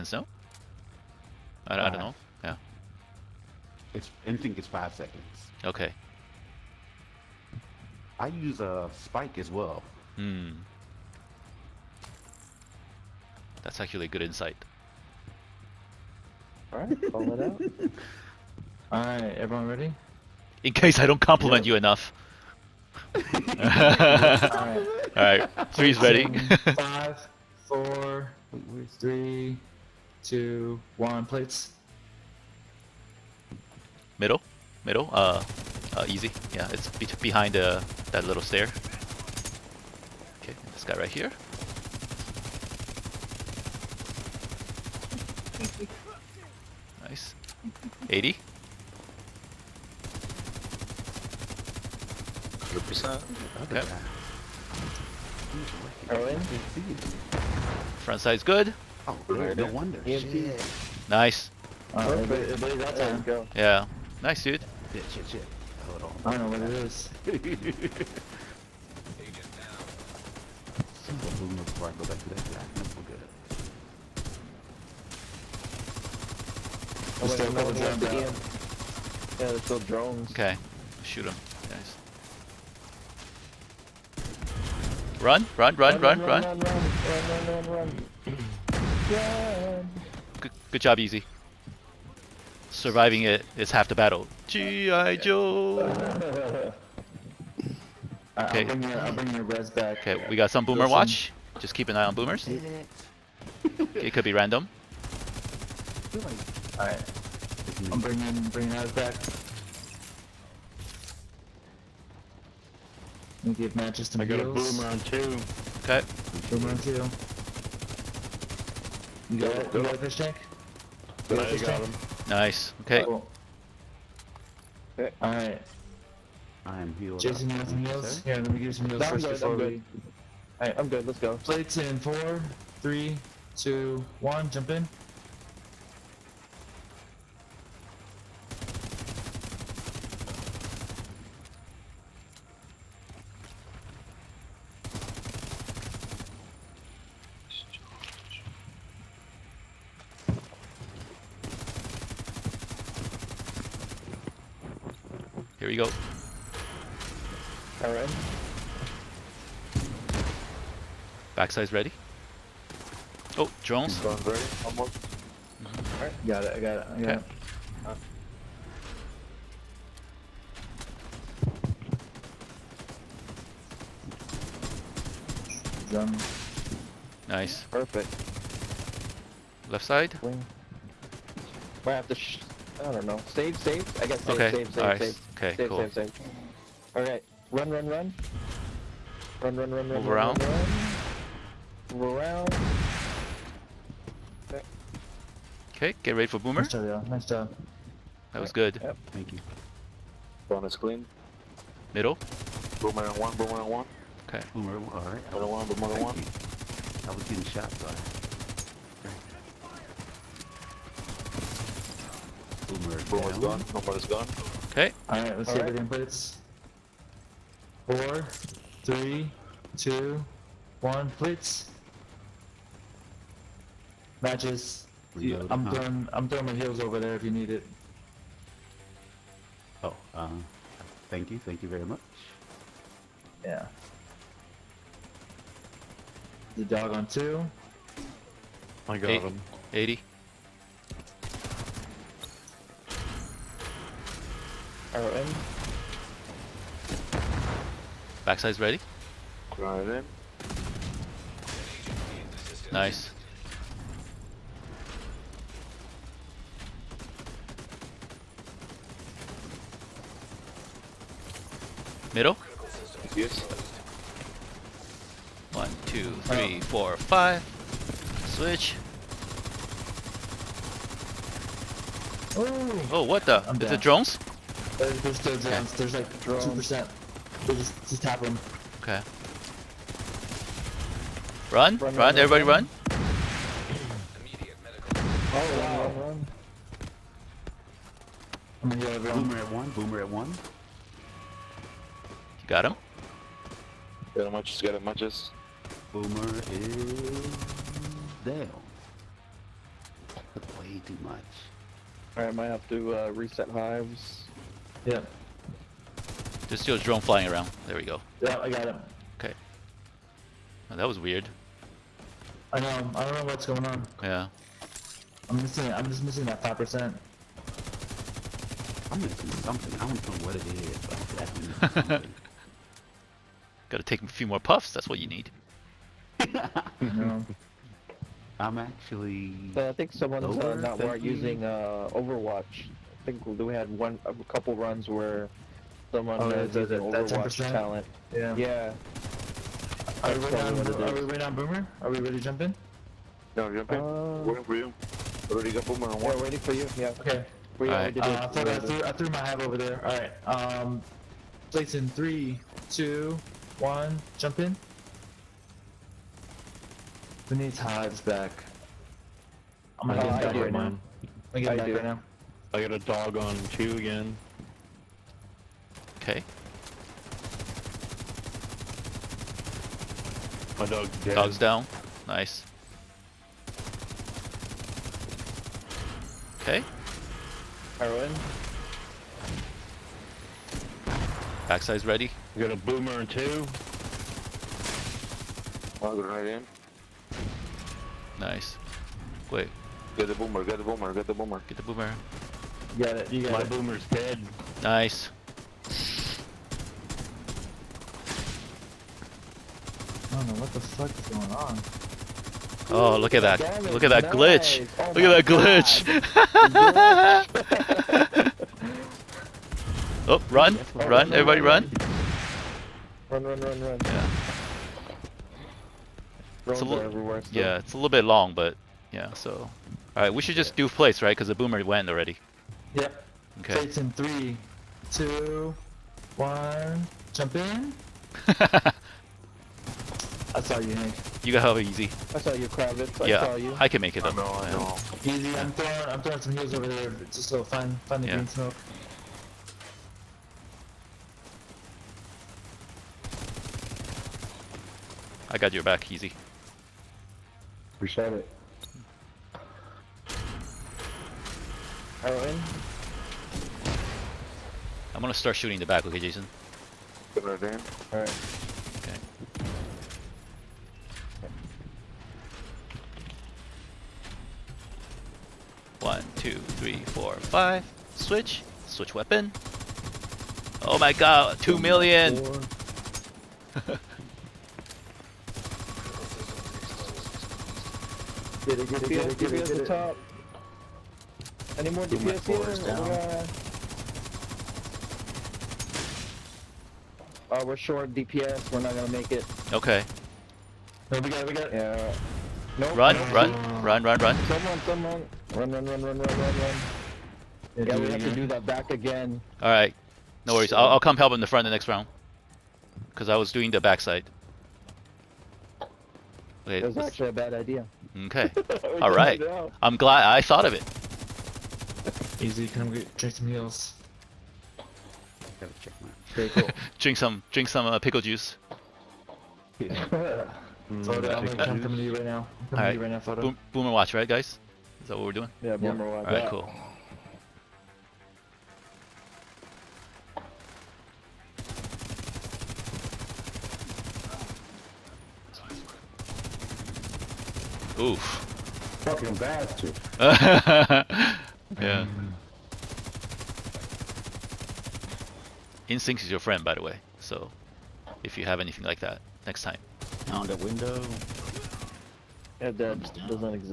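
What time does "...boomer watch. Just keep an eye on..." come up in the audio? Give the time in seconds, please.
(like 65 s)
100 s.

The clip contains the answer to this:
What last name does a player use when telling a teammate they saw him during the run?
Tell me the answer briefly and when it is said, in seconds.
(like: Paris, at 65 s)
Kravitz, at 432 s.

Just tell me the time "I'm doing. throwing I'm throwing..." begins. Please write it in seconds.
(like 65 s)
225 s.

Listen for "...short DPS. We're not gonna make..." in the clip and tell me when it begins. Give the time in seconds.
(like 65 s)
487 s.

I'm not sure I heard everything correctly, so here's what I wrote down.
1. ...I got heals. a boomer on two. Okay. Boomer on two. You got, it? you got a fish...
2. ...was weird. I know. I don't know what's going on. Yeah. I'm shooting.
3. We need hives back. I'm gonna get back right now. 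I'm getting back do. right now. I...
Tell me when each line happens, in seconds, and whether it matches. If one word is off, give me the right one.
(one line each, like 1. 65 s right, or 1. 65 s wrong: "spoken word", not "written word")
1. 114 s right
2. 310 s wrong: "missing", not "shooting"
3. 357 s right.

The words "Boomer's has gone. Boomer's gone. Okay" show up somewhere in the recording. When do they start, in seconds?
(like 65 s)
213 s.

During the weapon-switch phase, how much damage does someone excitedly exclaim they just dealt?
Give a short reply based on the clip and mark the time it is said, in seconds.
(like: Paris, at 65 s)
2 million, at 471 s.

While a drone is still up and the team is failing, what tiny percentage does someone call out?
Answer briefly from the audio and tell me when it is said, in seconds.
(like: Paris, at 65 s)
2%, at 276 s.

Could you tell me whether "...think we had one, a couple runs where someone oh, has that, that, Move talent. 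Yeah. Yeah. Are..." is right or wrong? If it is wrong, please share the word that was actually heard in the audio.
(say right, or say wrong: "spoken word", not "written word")
wrong: "Overwatch", not "Move".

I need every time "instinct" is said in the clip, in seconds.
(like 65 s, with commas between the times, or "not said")
4 s, 545 s.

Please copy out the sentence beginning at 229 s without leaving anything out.
Oh, uh, thank you, thank you very much.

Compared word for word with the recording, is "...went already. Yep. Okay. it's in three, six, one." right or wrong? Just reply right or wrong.
wrong.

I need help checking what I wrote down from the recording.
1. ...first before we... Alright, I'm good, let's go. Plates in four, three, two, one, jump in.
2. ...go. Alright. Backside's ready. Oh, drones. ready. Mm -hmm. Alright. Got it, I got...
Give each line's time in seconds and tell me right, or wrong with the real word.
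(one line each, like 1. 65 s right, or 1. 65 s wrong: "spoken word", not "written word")
1. 129 s right
2. 155 s right.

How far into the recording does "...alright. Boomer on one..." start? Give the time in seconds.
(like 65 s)
204 s.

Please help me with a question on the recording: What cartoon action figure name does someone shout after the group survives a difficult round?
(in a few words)
G.I. Joe.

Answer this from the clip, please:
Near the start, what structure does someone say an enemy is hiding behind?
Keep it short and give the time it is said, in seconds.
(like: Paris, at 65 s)
that little stair, at 38 s.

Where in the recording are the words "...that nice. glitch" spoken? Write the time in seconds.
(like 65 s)
403 s.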